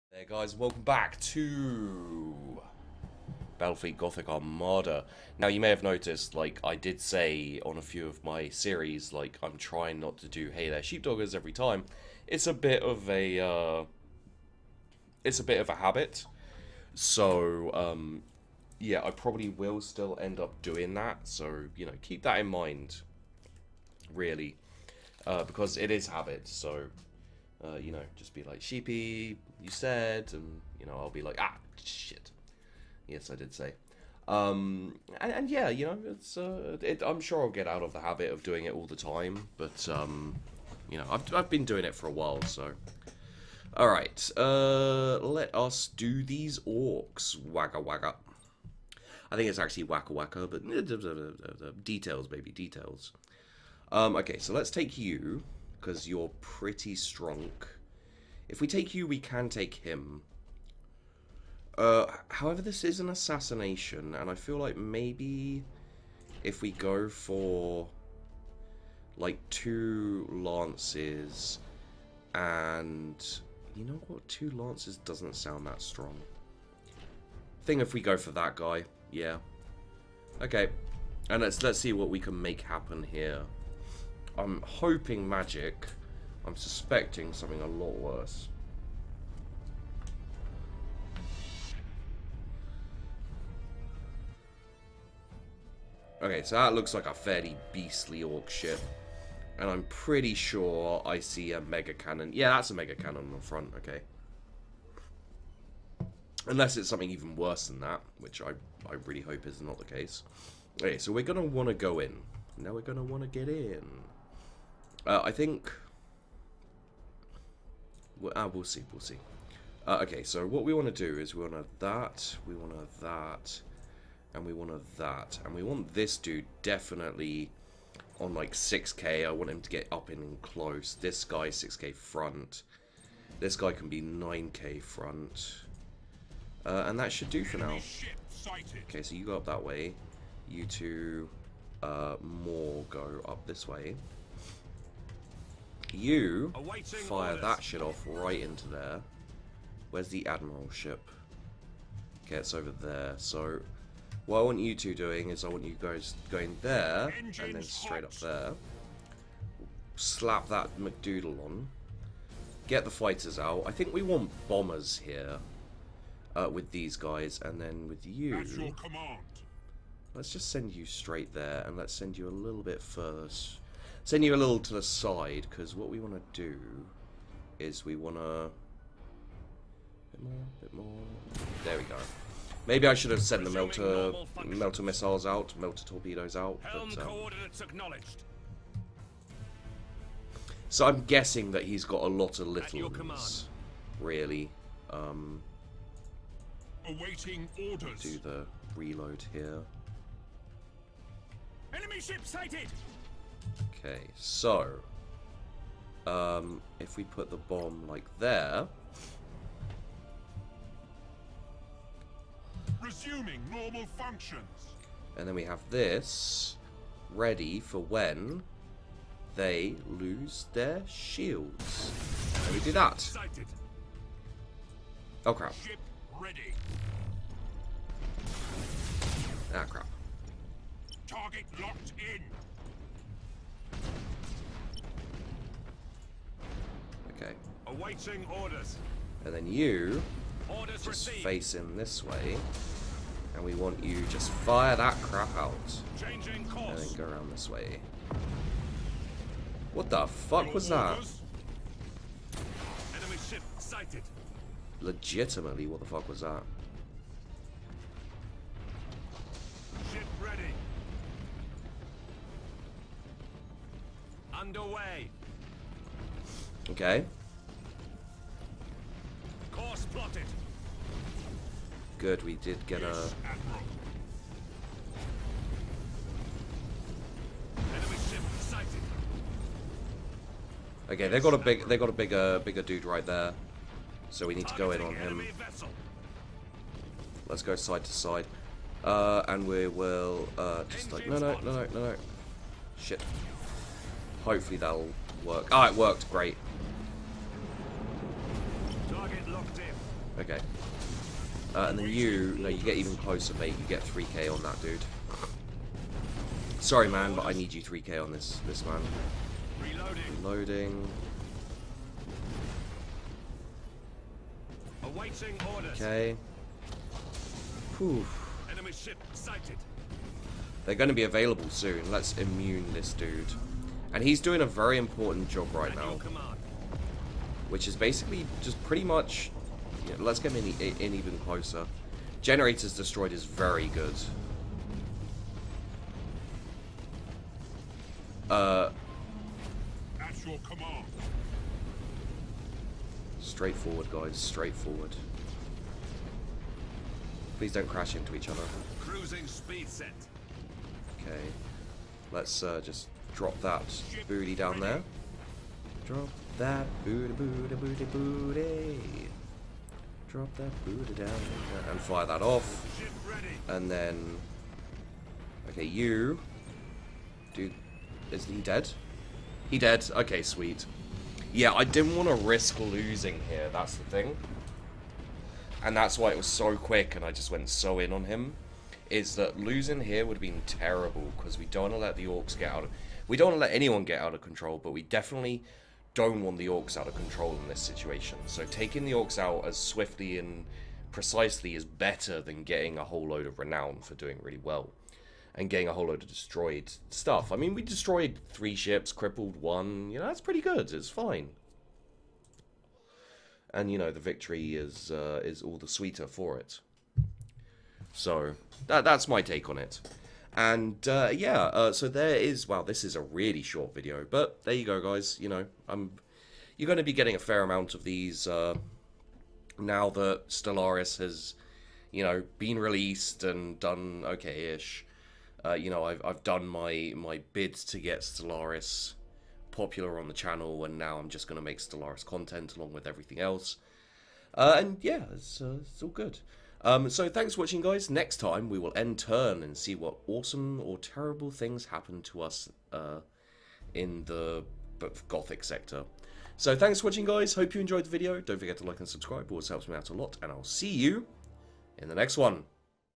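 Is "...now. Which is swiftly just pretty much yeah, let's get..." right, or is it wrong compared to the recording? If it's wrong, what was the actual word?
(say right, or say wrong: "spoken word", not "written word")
wrong: "basically", not "swiftly".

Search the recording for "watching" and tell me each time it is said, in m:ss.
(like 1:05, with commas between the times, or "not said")
7:17, 7:26.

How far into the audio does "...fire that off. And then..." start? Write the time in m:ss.
6:01.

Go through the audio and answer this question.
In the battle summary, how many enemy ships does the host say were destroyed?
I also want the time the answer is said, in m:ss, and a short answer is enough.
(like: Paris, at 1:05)
three, at 6:38.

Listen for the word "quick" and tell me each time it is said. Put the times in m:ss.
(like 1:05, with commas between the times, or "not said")
6:16.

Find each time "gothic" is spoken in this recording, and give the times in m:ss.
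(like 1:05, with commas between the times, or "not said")
0:03, 7:25.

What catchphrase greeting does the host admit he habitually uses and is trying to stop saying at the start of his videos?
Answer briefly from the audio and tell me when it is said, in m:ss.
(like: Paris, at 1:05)
Hey There Sheepdoggers, at 0:10.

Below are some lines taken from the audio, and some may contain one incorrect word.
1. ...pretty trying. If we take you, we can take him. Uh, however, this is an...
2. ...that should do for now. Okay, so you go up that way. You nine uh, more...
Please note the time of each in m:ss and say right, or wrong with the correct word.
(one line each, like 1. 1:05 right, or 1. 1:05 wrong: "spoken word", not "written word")
1. 0:56 wrong: "strong", not "trying"
2. 2:16 wrong: "two", not "nine".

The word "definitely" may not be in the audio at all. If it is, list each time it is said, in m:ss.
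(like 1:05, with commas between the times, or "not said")
2:06, 6:24.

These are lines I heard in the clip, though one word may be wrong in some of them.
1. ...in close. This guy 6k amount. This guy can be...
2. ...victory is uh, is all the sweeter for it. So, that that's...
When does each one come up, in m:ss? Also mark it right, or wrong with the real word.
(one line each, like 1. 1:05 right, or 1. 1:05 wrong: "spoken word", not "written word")
1. 2:10 wrong: "front", not "amount"
2. 6:44 right.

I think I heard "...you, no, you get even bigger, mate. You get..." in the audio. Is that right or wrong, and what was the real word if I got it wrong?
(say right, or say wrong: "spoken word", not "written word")
wrong: "closer", not "bigger".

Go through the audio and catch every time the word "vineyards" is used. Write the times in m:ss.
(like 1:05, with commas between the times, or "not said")
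not said.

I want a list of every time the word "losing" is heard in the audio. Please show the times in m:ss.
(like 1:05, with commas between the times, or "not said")
6:12, 6:19.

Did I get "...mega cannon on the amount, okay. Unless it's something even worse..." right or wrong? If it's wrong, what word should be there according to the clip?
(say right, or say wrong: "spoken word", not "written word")
wrong: "front", not "amount".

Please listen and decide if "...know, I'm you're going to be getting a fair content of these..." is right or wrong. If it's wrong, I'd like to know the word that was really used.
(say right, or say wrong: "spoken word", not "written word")
wrong: "amount", not "content".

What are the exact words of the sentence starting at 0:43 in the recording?
Alright, uh, let us do these orcs.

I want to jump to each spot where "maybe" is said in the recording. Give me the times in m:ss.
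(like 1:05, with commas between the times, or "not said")
1:04, 3:02.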